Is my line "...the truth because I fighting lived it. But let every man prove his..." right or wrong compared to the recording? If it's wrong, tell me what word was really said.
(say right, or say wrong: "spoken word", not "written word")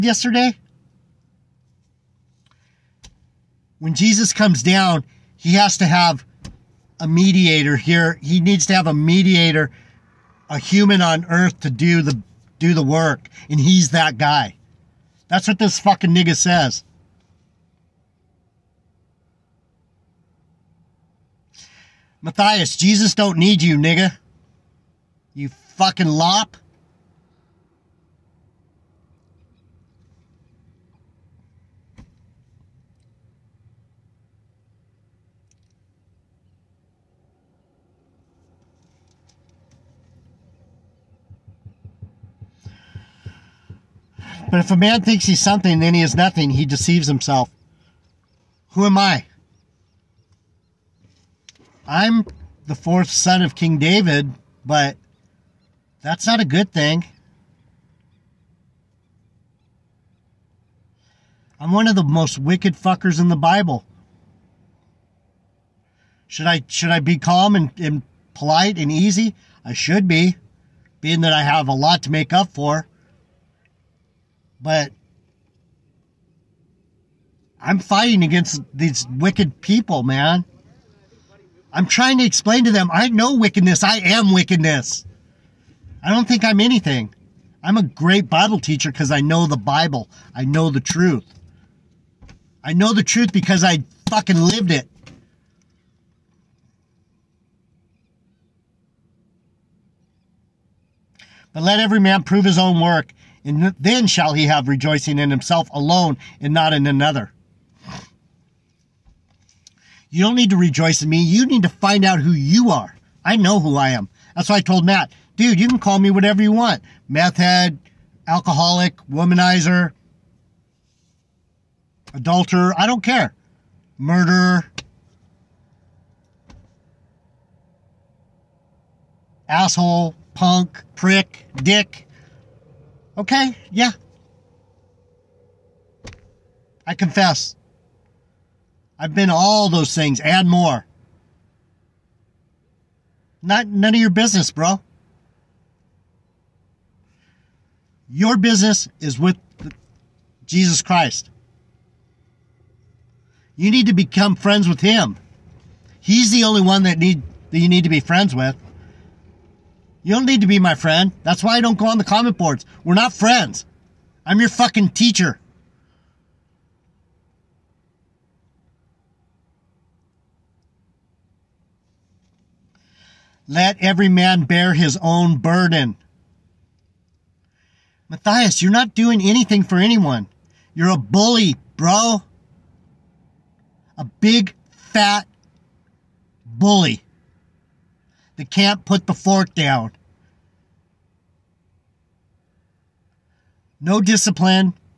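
wrong: "fucking", not "fighting".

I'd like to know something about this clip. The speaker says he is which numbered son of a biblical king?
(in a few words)
fourth.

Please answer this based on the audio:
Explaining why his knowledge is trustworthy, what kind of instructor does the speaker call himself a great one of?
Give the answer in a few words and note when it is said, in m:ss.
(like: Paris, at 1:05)
Bible teacher, at 1:28.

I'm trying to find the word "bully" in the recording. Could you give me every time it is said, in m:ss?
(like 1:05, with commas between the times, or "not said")
3:00, 3:06.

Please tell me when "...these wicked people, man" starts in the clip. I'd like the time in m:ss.
1:18.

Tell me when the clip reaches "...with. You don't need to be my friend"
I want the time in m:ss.
2:38.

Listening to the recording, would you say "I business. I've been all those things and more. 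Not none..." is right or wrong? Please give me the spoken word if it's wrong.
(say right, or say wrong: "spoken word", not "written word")
wrong: "confess", not "business".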